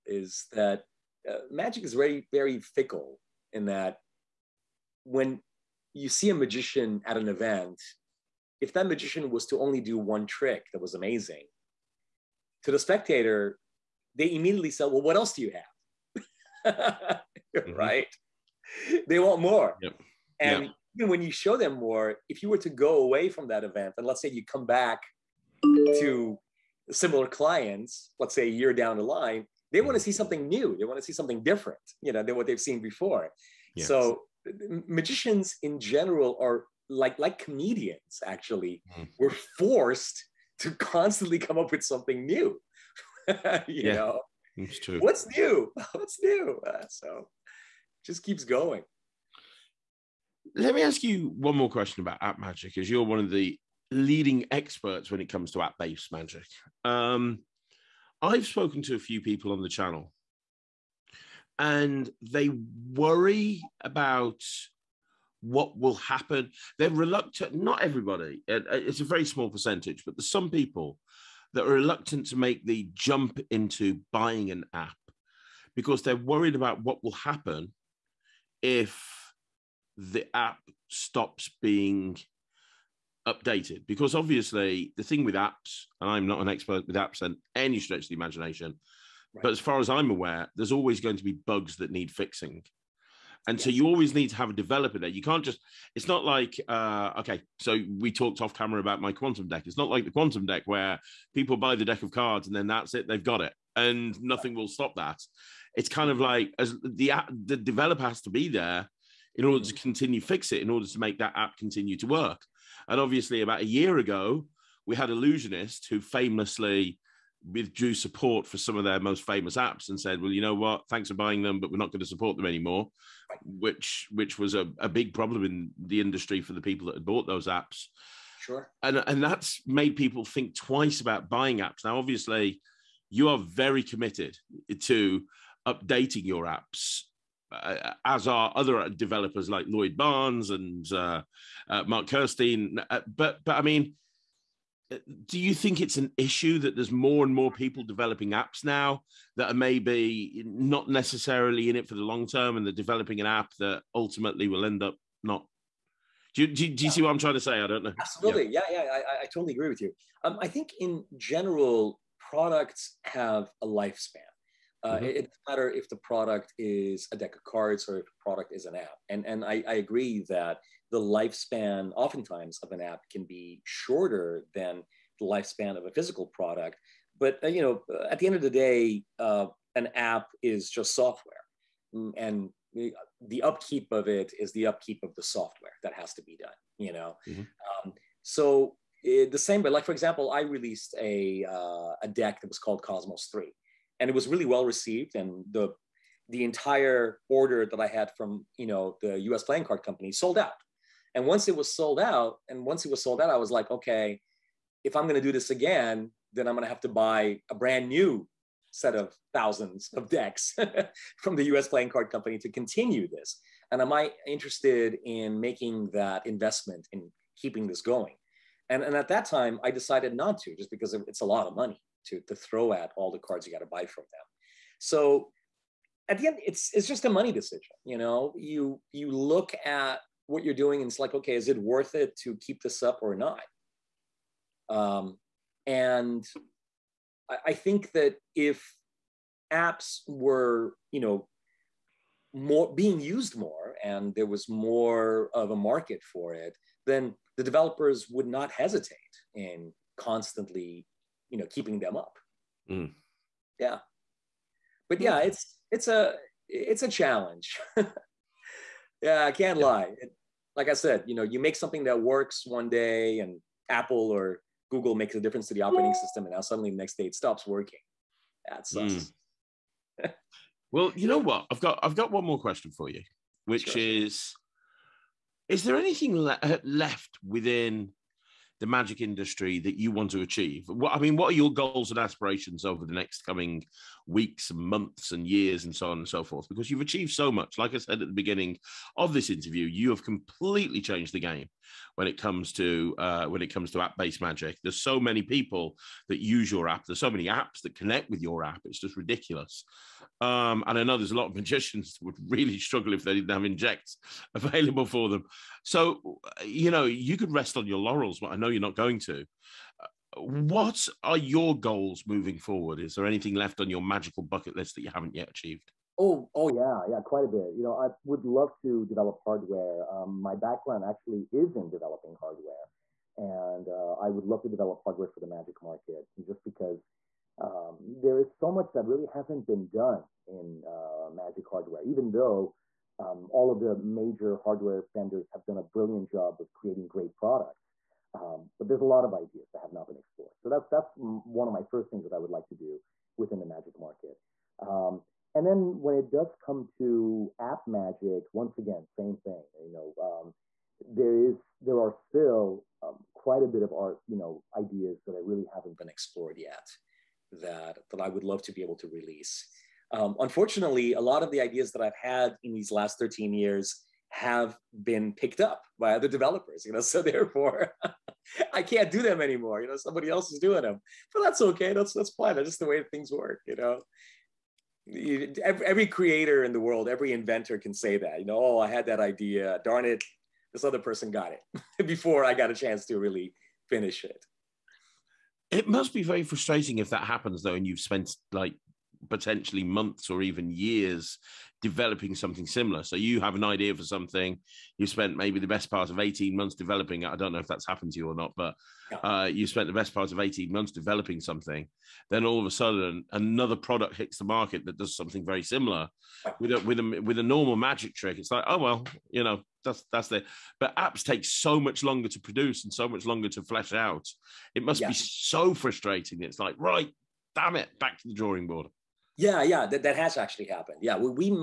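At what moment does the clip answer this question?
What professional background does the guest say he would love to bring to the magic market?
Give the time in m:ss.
5:21.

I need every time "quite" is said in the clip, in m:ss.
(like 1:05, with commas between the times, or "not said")
5:16, 5:53.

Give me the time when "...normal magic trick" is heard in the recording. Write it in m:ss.
6:47.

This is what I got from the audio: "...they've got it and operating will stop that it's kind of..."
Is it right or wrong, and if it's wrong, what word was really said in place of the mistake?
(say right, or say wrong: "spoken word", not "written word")
wrong: "nothing", not "operating".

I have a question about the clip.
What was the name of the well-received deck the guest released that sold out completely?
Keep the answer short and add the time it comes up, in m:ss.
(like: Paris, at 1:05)
Cosmos Three, at 3:12.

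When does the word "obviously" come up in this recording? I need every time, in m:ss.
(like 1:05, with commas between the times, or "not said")
1:24, 1:52, 2:11.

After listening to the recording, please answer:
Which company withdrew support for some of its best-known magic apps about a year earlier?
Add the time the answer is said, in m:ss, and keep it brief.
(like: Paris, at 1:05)
Illusionist, at 1:55.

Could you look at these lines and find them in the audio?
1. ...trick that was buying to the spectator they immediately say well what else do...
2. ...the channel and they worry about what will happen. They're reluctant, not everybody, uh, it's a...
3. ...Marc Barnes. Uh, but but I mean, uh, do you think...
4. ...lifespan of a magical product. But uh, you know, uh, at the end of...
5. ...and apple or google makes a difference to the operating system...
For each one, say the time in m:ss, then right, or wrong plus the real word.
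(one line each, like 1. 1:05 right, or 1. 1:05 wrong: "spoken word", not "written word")
1. 0:10 wrong: "amazing", not "buying"
2. 0:59 right
3. 2:21 wrong: "Kerstein", not "Barnes"
4. 2:55 wrong: "physical", not "magical"
5. 4:23 right.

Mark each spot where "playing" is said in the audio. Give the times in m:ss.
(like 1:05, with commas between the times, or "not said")
3:19, 3:31.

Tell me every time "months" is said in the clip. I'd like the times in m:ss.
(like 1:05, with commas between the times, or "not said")
4:44, 6:29, 6:36, 6:40.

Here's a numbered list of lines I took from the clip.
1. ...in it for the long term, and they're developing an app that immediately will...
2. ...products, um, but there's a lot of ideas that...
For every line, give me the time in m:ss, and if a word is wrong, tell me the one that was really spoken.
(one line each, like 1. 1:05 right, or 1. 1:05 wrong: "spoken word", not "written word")
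1. 2:31 wrong: "ultimately", not "immediately"
2. 5:37 right.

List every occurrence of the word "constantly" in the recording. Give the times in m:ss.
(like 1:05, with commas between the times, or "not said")
0:40, 4:09.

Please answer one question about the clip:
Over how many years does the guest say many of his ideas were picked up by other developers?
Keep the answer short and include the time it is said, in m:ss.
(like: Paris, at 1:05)
13, at 6:02.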